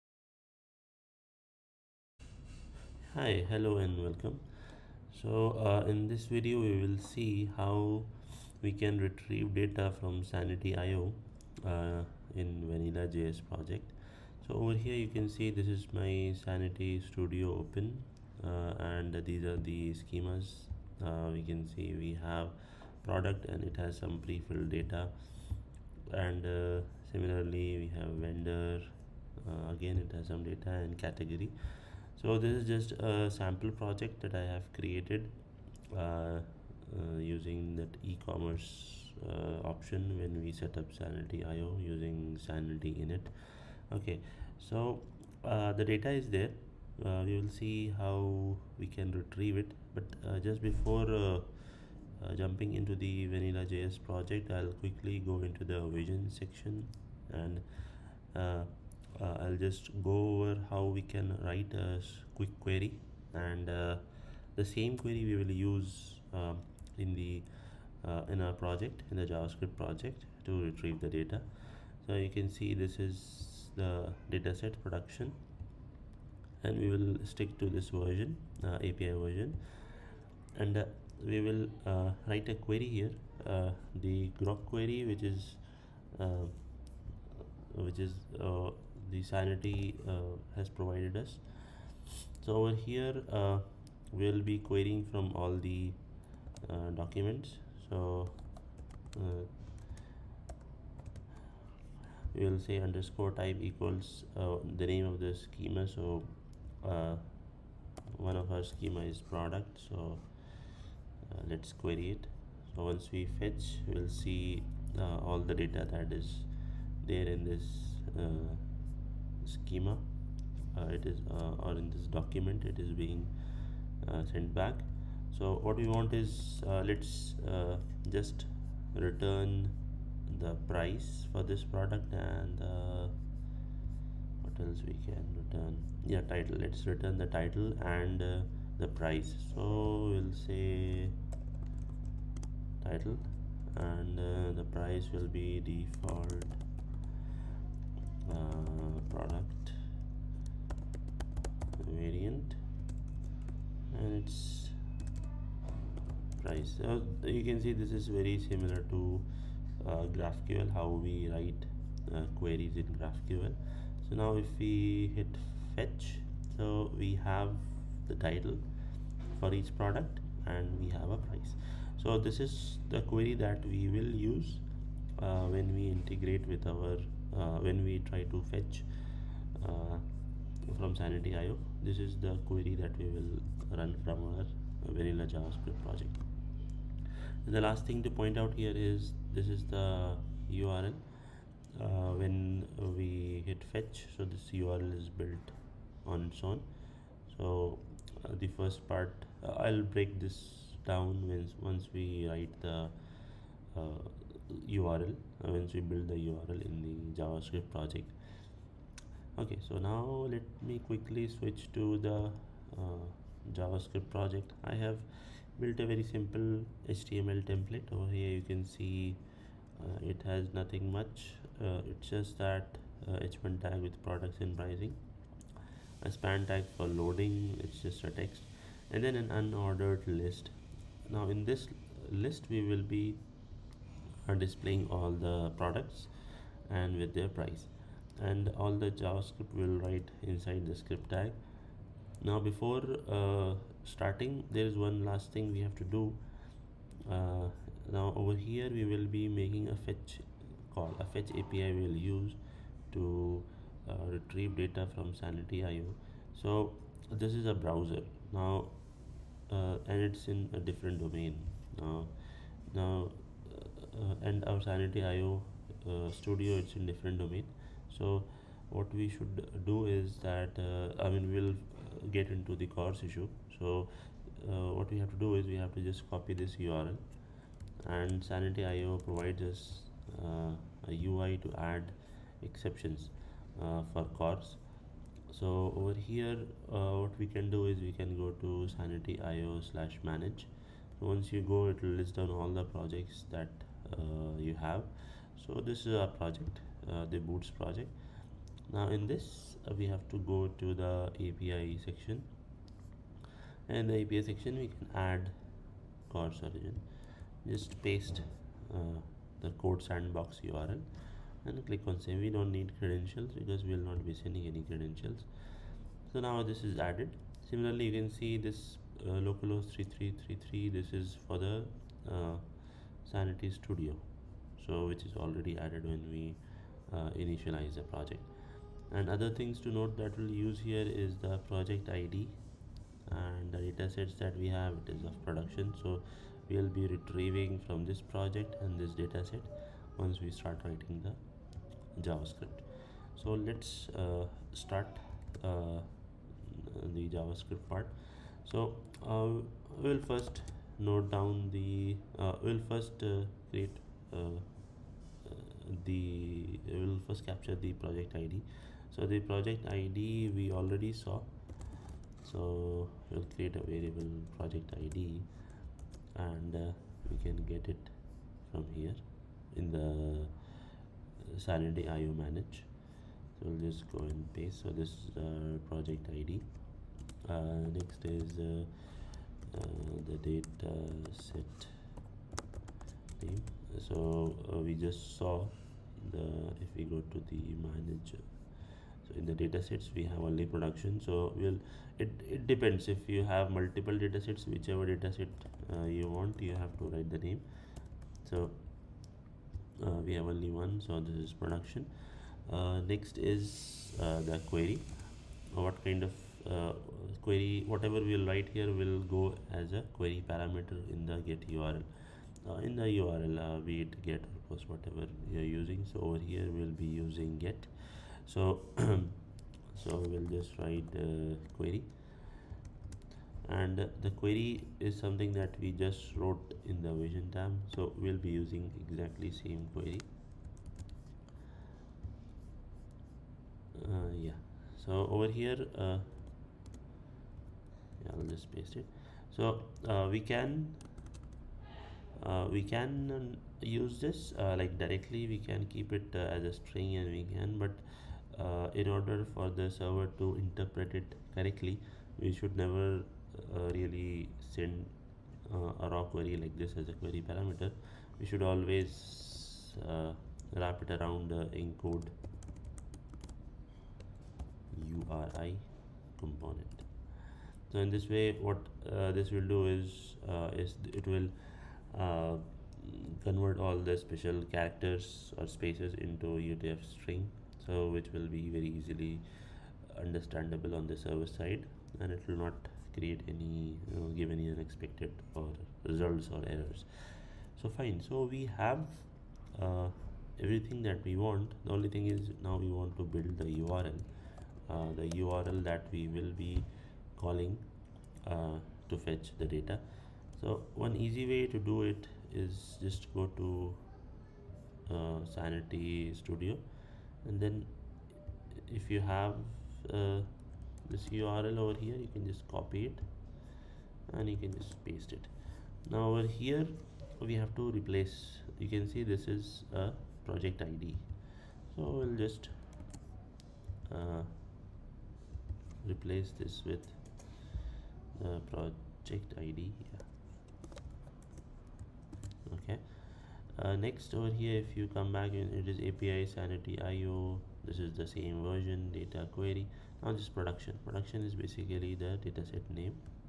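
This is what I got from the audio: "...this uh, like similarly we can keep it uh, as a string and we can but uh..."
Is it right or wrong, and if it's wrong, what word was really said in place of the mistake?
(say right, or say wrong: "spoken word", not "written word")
wrong: "directly", not "similarly".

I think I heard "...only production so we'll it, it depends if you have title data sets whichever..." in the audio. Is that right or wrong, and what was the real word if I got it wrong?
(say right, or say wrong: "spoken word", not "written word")
wrong: "multiple", not "title".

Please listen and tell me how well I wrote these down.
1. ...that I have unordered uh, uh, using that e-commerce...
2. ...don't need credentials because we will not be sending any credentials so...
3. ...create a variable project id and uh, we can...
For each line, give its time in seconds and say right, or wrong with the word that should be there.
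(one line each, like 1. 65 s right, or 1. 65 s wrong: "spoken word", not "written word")
1. 34 s wrong: "created", not "unordered"
2. 312 s right
3. 363 s right.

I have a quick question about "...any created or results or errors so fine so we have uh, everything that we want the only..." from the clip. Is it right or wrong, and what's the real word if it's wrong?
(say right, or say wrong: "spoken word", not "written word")
wrong: "unexpected", not "created".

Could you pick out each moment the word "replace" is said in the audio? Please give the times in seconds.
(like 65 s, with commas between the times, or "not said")
517 s, 525 s.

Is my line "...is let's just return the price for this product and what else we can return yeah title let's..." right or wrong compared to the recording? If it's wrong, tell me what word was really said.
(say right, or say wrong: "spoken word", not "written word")
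right.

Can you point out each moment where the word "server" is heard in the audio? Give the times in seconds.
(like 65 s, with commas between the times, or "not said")
449 s, 480 s.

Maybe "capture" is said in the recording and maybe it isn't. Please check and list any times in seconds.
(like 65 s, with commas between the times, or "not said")
357 s.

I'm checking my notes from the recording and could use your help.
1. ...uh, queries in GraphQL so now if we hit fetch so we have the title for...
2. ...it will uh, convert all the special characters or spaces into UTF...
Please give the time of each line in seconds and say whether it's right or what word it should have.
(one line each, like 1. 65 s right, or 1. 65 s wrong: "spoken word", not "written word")
1. 162 s right
2. 470 s right.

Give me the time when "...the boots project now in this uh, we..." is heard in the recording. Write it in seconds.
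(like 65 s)
297 s.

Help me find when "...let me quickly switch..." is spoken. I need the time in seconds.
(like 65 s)
210 s.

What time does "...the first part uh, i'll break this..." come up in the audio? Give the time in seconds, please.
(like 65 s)
198 s.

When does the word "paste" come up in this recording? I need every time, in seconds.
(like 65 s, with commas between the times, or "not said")
307 s, 374 s, 438 s, 514 s.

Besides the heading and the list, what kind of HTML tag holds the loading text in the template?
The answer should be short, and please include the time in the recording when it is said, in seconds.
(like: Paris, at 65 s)
span, at 226 s.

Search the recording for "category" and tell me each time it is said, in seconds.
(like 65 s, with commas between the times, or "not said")
30 s.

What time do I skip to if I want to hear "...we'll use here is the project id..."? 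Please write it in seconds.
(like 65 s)
330 s.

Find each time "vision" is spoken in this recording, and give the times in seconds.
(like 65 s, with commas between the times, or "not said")
55 s, 426 s.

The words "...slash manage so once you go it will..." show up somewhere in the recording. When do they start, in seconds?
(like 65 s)
289 s.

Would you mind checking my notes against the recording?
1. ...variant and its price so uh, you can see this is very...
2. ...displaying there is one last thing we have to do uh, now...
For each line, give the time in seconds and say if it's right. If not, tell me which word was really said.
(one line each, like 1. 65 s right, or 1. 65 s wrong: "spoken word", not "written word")
1. 151 s right
2. 243 s wrong: "starting", not "displaying".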